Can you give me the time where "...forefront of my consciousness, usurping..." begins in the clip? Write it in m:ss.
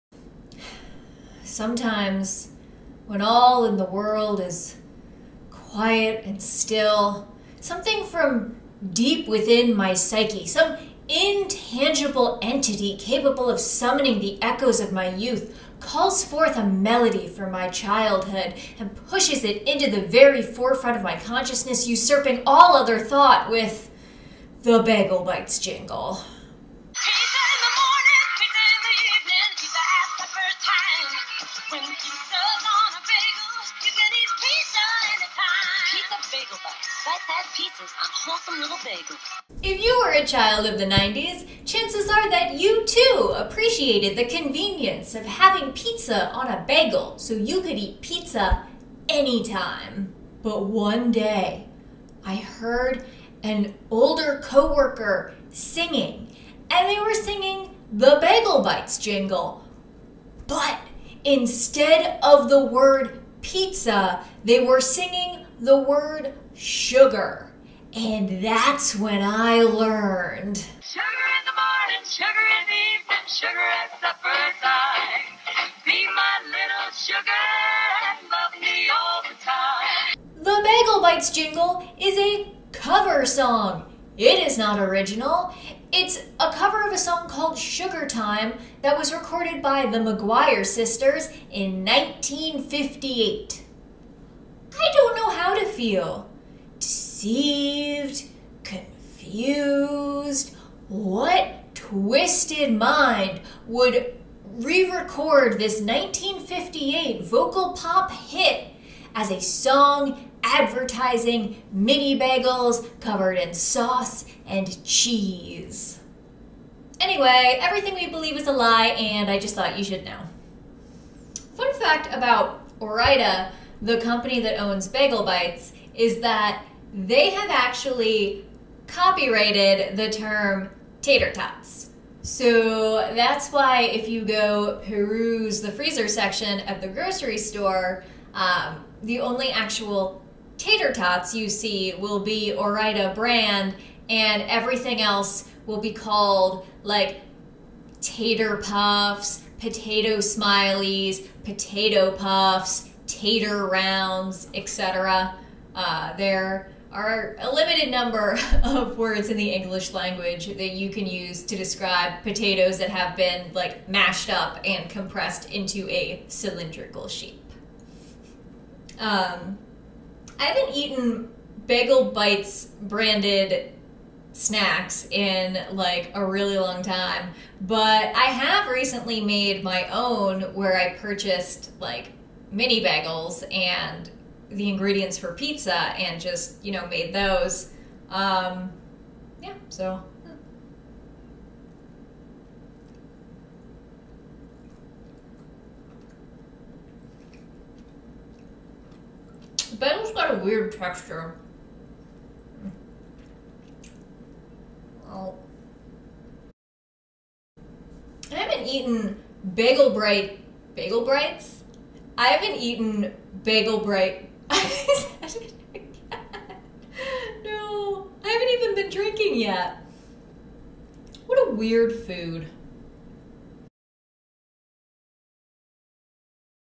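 0:20.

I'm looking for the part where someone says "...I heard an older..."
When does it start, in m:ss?
0:52.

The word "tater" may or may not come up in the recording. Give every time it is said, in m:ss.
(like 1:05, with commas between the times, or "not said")
2:11, 2:20, 2:27, 2:33.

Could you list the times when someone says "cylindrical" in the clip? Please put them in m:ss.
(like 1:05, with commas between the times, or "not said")
2:46.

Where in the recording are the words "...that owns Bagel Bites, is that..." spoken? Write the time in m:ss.
2:04.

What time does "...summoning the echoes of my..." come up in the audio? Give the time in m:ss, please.
0:13.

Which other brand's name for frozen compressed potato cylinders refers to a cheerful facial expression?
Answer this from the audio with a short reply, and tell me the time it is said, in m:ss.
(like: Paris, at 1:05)
potato smileys, at 2:29.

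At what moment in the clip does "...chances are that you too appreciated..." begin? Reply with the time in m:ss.
0:41.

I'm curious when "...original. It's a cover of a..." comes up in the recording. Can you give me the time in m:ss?
1:24.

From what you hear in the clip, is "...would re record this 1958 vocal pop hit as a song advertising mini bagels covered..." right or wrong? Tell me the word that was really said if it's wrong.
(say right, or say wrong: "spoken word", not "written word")
right.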